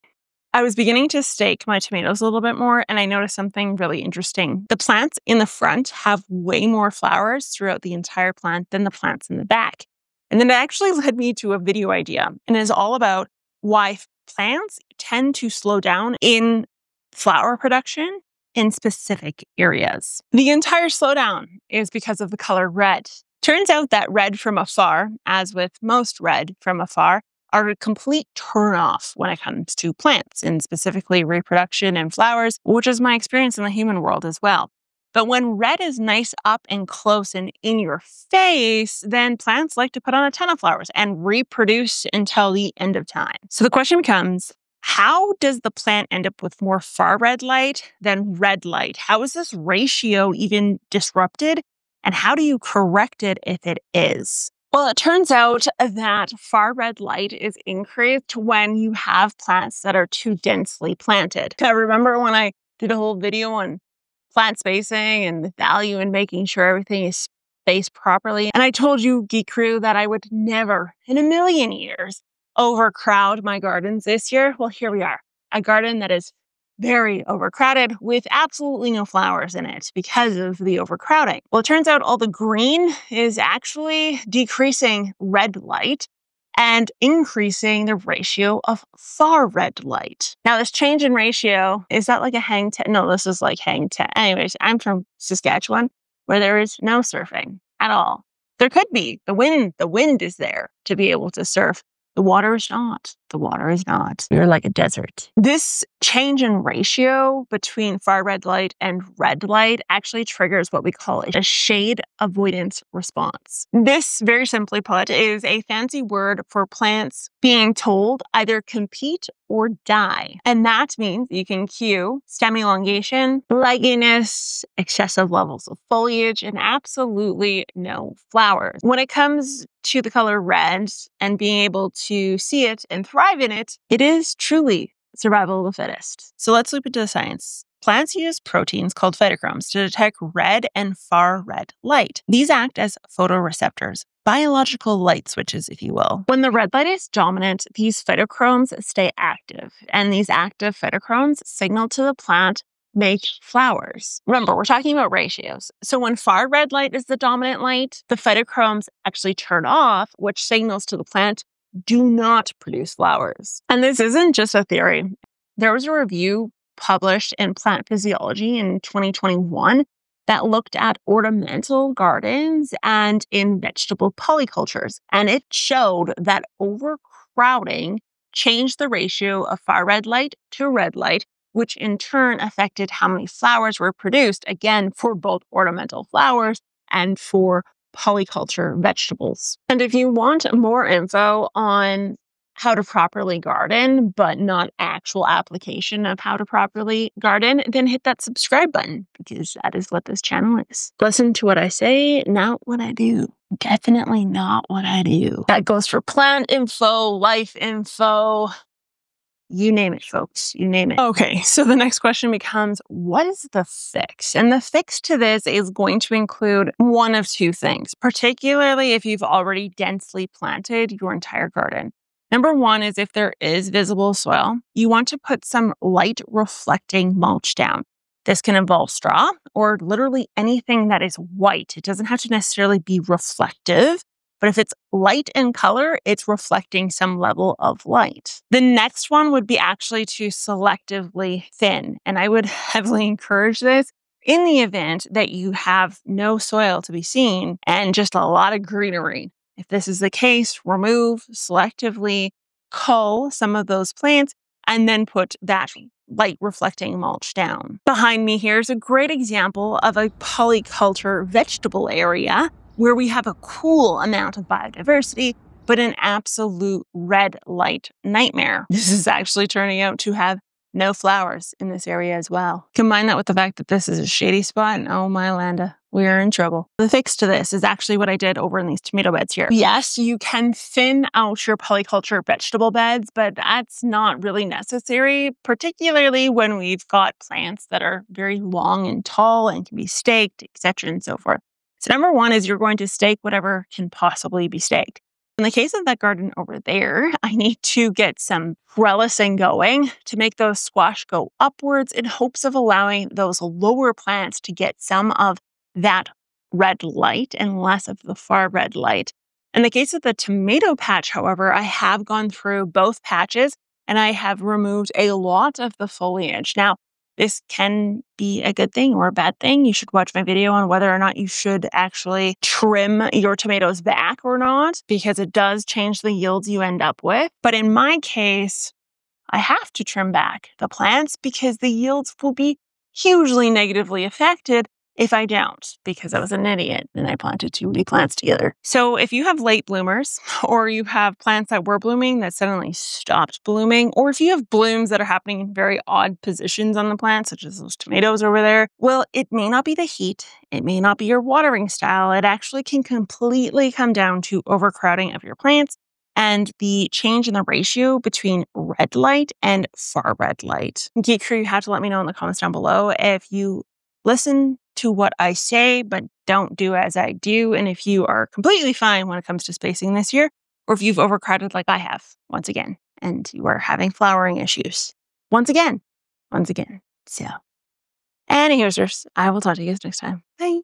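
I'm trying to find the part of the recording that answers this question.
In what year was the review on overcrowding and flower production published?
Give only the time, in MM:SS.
02:48.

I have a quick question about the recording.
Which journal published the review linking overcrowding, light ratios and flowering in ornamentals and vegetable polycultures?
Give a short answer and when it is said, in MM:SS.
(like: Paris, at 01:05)
Plant Physiology, at 02:47.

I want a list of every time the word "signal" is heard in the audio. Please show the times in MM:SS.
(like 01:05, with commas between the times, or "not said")
02:31, 02:40.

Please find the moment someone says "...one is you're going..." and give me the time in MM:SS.
04:52.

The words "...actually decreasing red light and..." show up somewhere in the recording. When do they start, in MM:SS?
01:23.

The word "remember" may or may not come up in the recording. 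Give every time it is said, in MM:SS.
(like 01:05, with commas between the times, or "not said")
01:01, 02:34.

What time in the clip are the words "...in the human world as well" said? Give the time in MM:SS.
00:33.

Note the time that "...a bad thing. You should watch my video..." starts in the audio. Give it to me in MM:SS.
05:19.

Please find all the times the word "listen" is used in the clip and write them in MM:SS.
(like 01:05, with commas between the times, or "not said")
03:21, 06:04.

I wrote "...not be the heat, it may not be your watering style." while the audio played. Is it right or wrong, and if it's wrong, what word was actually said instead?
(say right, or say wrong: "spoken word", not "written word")
right.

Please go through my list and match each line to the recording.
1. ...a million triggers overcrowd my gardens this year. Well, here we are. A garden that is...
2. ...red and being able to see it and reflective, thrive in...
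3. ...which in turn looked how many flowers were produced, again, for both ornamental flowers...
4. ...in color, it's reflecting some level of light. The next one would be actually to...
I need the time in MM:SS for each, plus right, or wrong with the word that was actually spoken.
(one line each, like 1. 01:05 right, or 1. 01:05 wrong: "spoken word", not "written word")
1. 01:11 wrong: "years", not "triggers"
2. 02:10 wrong: "thrive", not "reflective"
3. 03:01 wrong: "affected", not "looked"
4. 03:55 right.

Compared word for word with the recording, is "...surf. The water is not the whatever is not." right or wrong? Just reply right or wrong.
wrong.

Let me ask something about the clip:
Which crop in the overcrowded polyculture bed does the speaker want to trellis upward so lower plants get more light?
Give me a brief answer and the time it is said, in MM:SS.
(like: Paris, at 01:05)
squash, at 05:00.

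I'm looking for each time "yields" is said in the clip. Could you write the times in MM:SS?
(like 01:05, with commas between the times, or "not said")
05:26, 05:31.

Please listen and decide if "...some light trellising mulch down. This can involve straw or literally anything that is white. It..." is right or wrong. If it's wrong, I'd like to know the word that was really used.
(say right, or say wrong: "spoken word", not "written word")
wrong: "reflecting", not "trellising".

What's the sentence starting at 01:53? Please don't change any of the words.
This, very simply put, is a fancy word for plants being told either compete or die.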